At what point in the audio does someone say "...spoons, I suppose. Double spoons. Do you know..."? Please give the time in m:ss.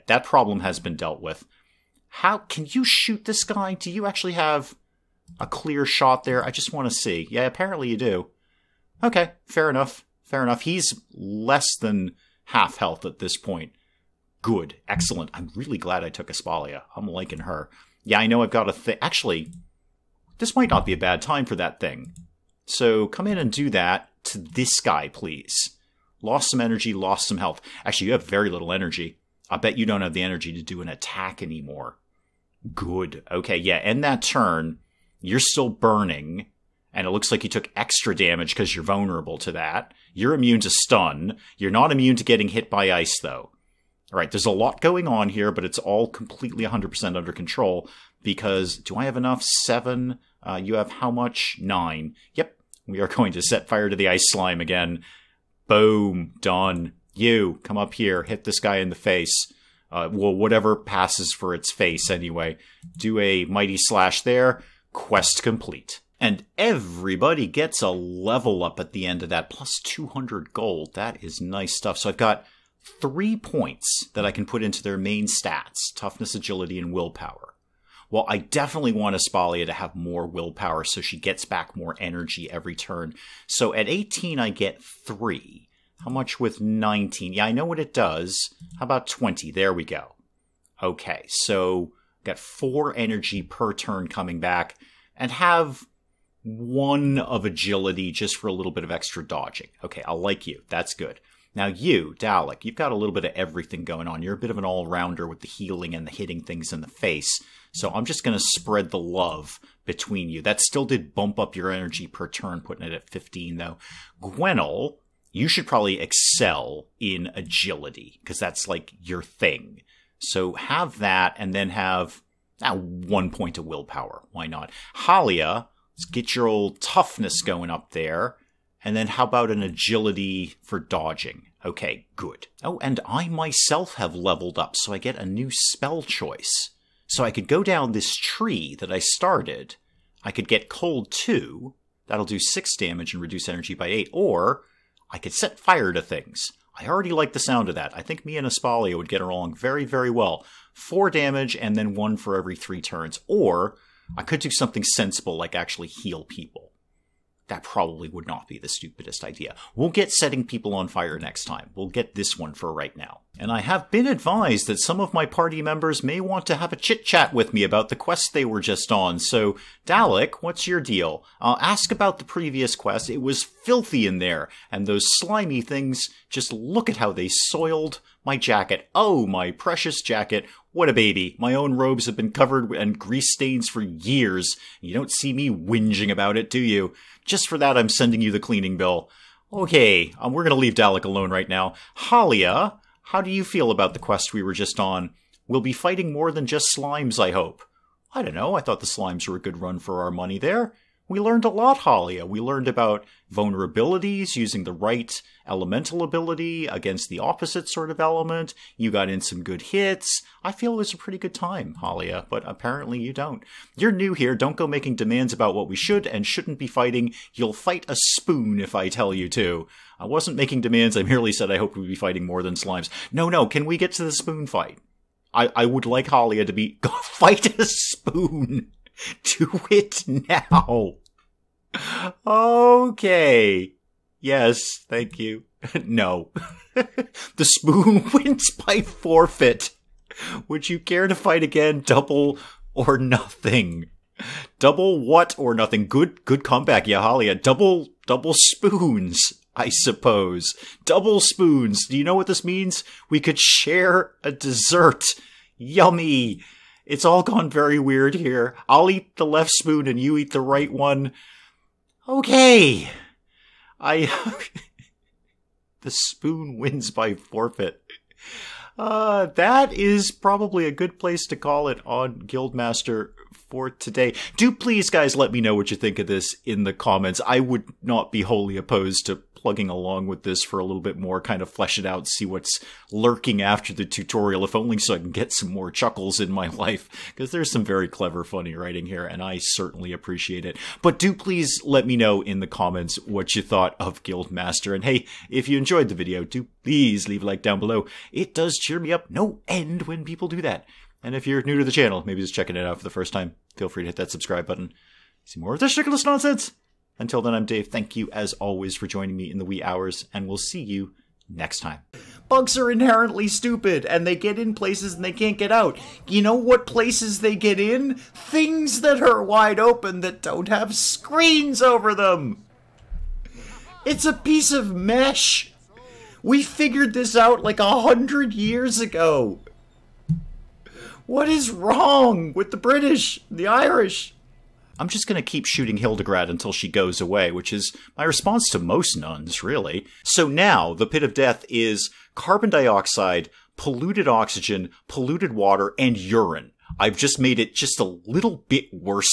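4:08.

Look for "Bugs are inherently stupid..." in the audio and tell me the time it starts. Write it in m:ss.
5:12.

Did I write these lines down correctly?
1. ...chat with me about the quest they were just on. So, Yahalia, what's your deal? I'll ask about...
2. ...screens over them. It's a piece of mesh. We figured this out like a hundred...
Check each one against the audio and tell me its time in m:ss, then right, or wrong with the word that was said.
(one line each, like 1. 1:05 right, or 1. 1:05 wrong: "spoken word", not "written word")
1. 2:47 wrong: "Dalek", not "Yahalia"
2. 5:20 right.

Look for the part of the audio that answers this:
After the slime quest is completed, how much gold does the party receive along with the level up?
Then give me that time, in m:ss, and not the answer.
1:09.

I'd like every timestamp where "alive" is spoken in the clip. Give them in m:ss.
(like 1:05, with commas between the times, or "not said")
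not said.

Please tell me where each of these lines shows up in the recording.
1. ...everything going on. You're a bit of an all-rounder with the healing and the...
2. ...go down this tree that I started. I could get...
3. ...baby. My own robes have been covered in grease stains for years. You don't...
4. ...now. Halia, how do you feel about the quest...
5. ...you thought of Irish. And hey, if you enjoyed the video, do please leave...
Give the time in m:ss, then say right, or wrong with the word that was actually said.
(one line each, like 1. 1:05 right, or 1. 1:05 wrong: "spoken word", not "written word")
1. 1:43 right
2. 2:17 right
3. 3:00 right
4. 3:11 right
5. 4:53 wrong: "Guildmaster", not "Irish".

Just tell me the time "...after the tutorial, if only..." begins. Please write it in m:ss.
4:43.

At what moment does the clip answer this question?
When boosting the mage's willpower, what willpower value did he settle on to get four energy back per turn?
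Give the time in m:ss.
1:29.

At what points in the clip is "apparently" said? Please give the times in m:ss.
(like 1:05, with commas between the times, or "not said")
0:07, 3:32.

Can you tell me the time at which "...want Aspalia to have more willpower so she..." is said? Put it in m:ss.
1:18.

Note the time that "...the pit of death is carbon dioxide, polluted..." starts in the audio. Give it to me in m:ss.
5:40.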